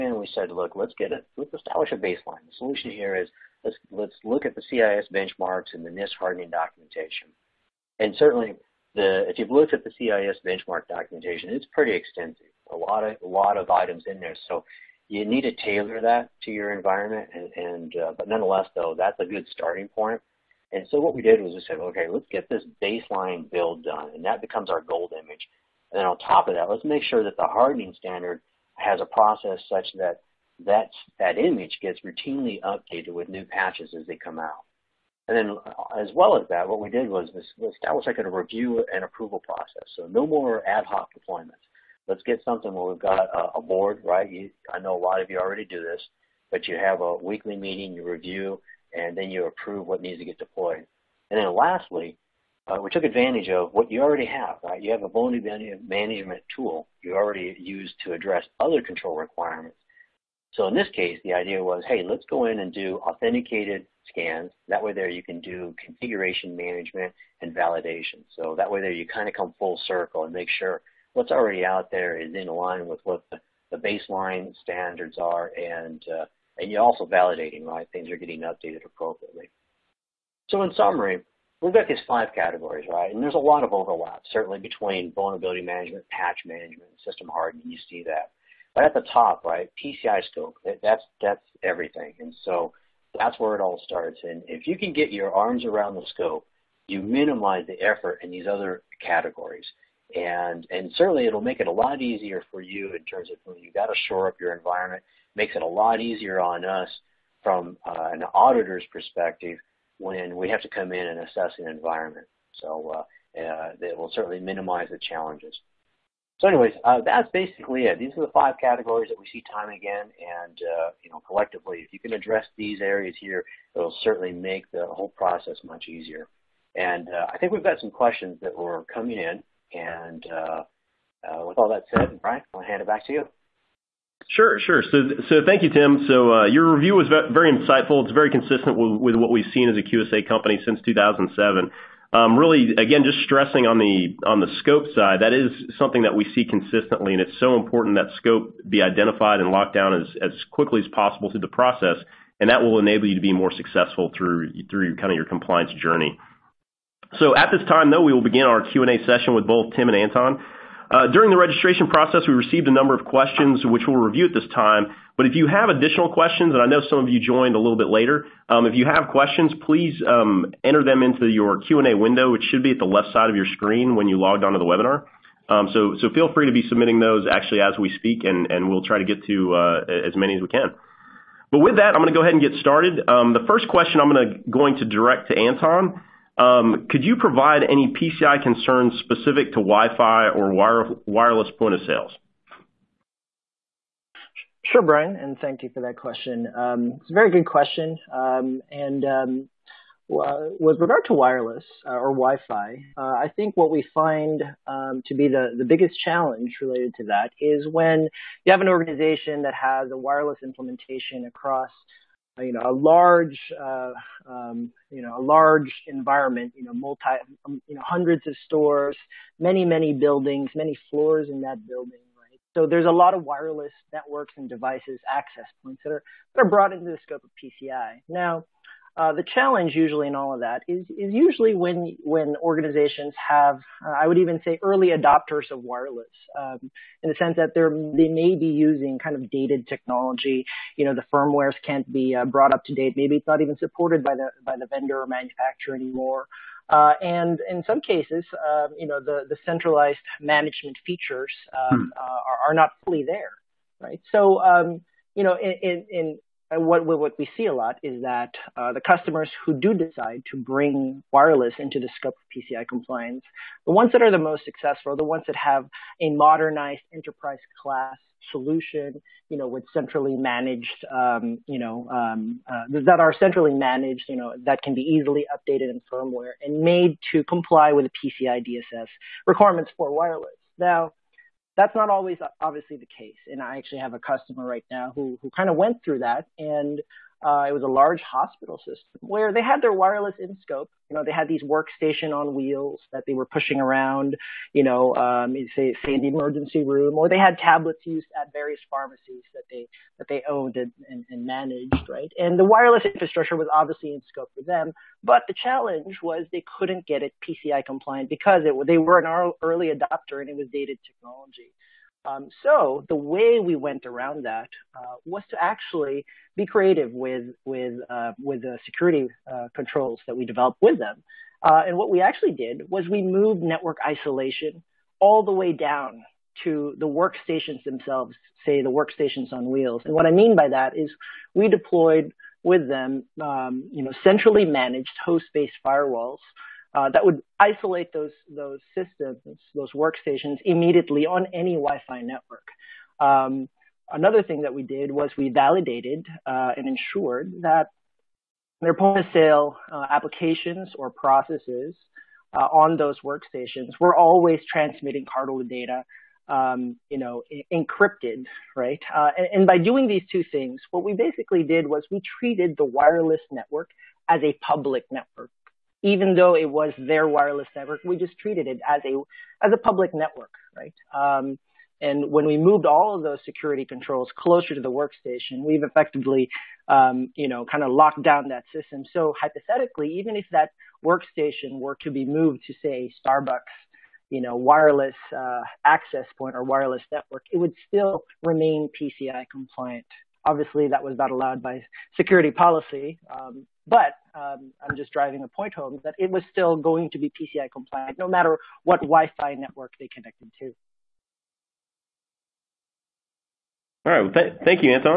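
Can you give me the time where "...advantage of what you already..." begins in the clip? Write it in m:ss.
0:53.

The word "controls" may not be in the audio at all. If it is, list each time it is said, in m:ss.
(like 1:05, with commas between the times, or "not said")
0:58, 5:19, 6:13.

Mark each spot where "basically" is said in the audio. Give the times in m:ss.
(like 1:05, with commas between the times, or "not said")
1:57, 6:00.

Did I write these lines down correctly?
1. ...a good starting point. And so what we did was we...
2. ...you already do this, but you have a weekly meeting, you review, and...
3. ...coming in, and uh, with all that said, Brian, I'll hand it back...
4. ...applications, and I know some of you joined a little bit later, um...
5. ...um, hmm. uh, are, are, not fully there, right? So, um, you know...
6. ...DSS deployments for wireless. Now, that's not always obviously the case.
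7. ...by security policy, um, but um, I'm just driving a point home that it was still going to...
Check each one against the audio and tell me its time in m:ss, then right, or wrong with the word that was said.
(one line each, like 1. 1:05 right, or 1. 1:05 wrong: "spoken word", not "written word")
1. 0:19 right
2. 0:45 right
3. 2:08 right
4. 2:46 wrong: "questions", not "applications"
5. 4:11 right
6. 4:38 wrong: "requirements", not "deployments"
7. 6:31 right.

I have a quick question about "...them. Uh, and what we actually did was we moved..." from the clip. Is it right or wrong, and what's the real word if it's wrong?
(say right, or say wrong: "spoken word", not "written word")
right.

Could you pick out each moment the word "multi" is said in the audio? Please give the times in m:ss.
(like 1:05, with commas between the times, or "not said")
3:36.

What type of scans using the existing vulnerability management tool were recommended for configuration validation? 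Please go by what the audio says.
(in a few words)
Authenticated scans.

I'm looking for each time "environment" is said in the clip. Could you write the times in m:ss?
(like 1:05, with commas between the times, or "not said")
0:16, 1:44, 1:51, 3:35.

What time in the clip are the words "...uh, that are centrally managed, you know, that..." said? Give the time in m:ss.
4:32.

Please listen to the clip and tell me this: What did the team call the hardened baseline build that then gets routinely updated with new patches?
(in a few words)
Gold image.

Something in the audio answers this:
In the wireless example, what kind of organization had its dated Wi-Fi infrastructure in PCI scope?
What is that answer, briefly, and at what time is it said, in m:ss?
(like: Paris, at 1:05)
Hospital system, at 4:48.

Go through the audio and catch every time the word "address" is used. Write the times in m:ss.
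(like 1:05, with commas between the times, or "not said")
0:58, 2:02.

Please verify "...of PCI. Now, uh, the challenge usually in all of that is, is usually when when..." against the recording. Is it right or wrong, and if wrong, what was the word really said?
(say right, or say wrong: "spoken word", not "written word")
right.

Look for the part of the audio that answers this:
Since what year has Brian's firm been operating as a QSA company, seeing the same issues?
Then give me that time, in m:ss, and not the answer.
2:20.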